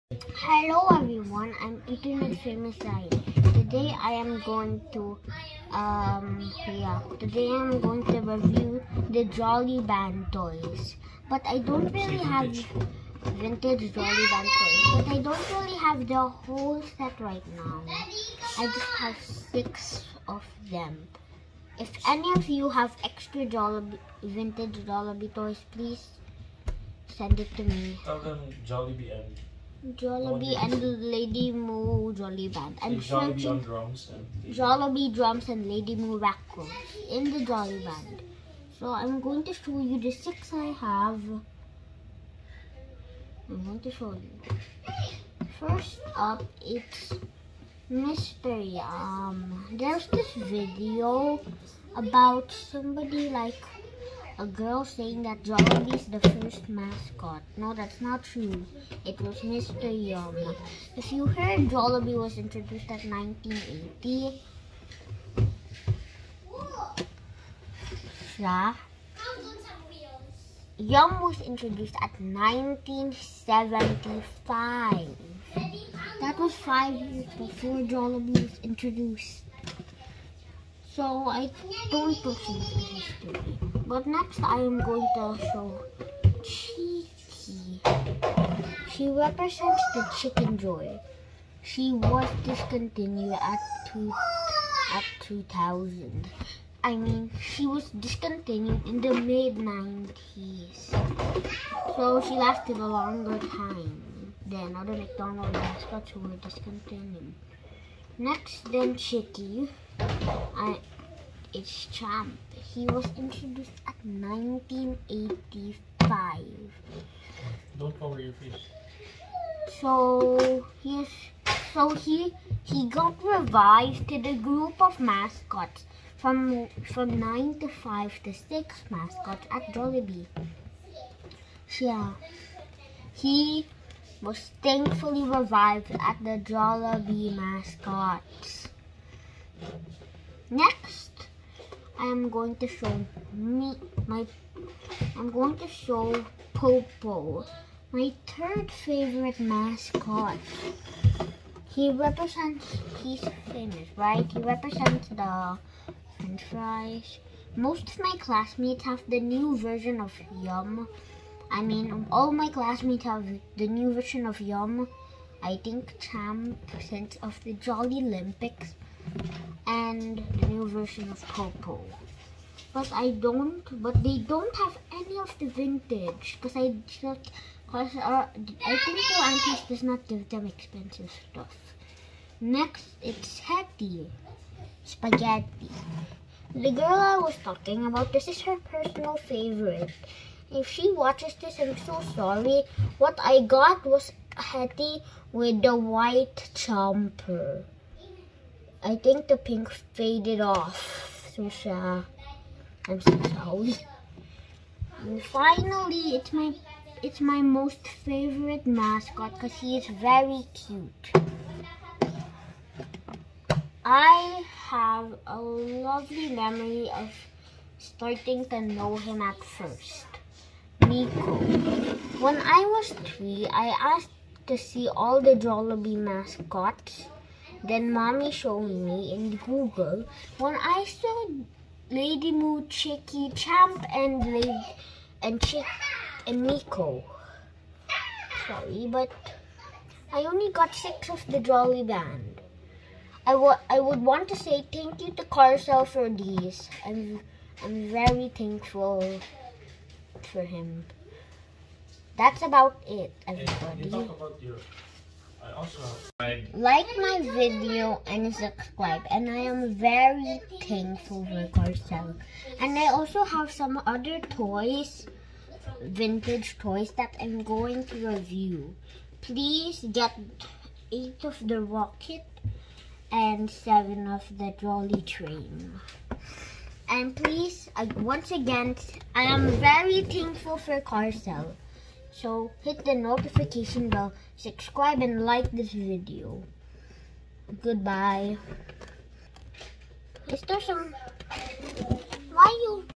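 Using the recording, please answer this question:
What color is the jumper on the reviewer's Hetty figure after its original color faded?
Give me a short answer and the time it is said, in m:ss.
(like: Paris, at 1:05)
White, at 3:15.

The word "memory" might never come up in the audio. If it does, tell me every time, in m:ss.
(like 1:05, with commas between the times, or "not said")
3:36.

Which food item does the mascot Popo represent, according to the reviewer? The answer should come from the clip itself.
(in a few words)
French fries.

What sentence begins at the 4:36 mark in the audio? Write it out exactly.
And please, uh, once again, I am very thankful for Carcel.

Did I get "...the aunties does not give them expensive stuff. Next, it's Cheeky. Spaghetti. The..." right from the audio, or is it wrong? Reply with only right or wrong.
wrong.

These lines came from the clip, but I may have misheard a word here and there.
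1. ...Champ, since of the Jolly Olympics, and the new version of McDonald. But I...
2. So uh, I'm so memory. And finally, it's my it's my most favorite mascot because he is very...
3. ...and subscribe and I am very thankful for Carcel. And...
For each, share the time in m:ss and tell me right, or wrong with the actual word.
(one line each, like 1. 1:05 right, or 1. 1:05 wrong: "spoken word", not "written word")
1. 2:45 wrong: "Popo", not "McDonald"
2. 3:21 wrong: "sorry", not "memory"
3. 4:18 right.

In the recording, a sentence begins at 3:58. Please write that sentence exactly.
Sorry, but I only got six of the Jolly Band.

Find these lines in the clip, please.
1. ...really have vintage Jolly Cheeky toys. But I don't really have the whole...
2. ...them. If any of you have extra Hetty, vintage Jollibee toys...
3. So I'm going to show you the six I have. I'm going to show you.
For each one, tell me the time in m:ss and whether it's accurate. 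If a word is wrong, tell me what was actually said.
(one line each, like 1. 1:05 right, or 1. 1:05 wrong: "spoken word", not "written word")
1. 0:11 wrong: "Band", not "Cheeky"
2. 0:20 wrong: "Jollibee", not "Hetty"
3. 0:38 right.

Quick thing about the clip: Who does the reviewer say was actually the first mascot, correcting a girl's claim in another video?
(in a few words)
Mr. Yum.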